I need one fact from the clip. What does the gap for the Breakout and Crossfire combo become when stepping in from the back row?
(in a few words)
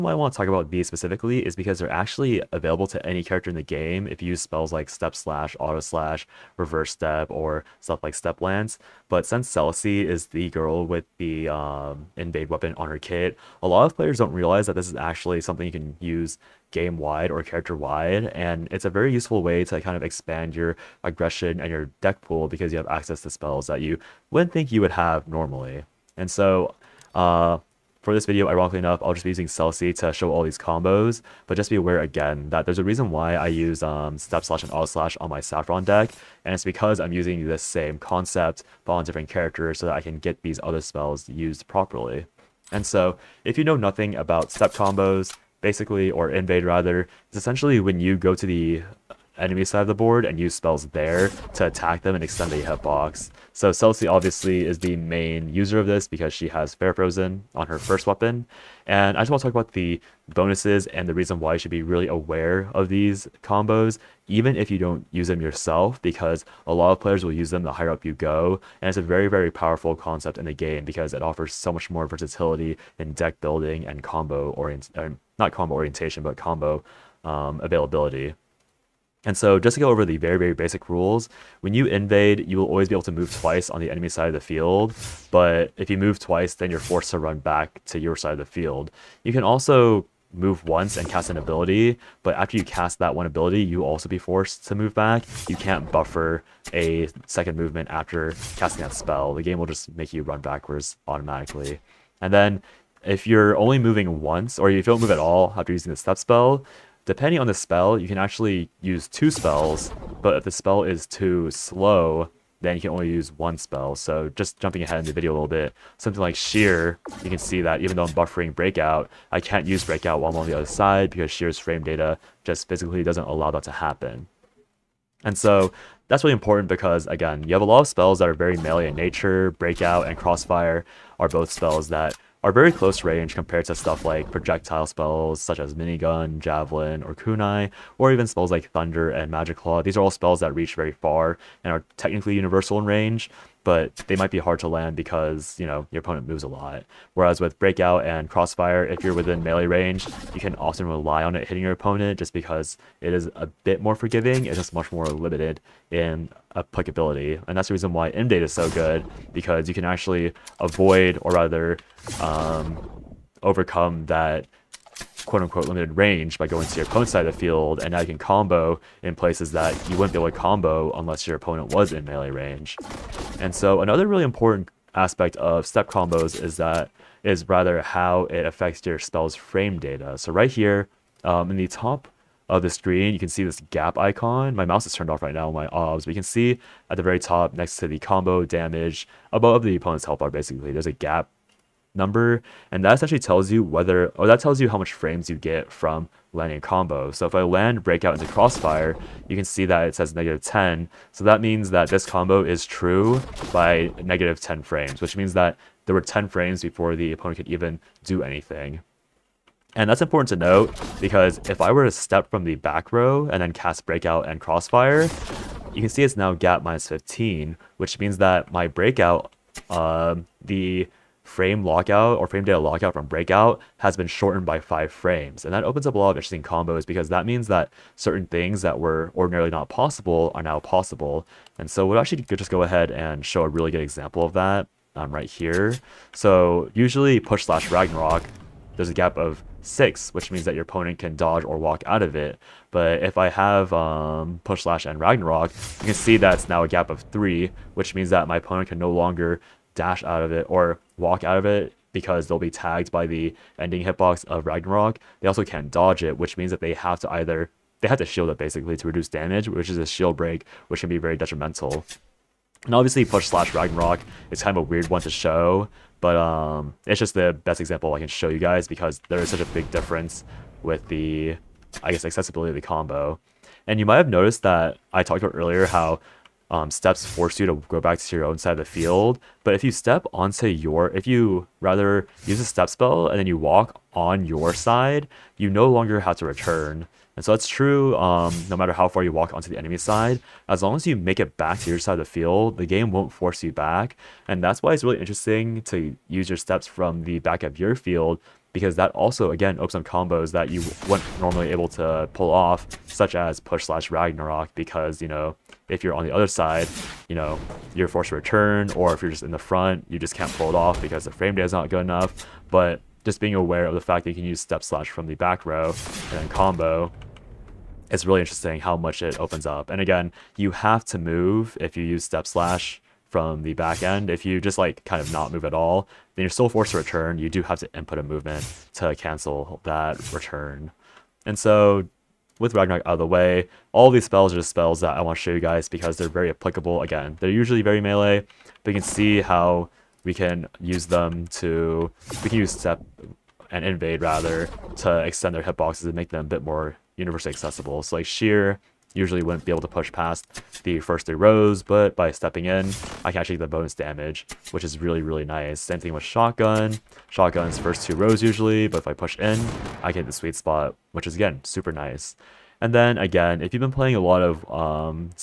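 -15.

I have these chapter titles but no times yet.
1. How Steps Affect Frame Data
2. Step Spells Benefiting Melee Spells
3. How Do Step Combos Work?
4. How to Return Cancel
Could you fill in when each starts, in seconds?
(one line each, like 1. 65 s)
1. 172 s
2. 333 s
3. 41 s
4. 272 s.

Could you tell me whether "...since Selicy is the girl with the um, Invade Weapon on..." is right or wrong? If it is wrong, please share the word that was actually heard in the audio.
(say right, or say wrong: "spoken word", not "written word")
right.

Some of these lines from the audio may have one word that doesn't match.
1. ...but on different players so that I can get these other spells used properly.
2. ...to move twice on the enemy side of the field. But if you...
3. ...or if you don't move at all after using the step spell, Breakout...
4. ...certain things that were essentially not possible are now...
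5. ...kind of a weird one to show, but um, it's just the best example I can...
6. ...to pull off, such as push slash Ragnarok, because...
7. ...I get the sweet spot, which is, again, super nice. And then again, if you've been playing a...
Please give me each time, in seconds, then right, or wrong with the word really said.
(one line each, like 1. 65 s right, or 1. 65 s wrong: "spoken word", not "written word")
1. 38 s wrong: "characters", not "players"
2. 83 s right
3. 104 s wrong: "Depending", not "Breakout"
4. 227 s wrong: "ordinarily", not "essentially"
5. 264 s right
6. 301 s right
7. 359 s right.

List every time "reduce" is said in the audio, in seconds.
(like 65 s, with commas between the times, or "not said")
258 s.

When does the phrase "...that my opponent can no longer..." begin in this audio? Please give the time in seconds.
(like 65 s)
248 s.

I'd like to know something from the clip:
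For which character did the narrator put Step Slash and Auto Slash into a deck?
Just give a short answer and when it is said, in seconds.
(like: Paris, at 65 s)
Saffron, at 35 s.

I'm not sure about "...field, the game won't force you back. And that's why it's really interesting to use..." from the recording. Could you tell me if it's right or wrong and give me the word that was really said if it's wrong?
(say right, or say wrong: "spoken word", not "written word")
right.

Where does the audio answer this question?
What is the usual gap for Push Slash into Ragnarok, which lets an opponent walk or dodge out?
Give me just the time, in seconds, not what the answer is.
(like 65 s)
239 s.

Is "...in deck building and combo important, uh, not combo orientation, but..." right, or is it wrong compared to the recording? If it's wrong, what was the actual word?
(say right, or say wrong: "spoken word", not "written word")
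wrong: "orient", not "important".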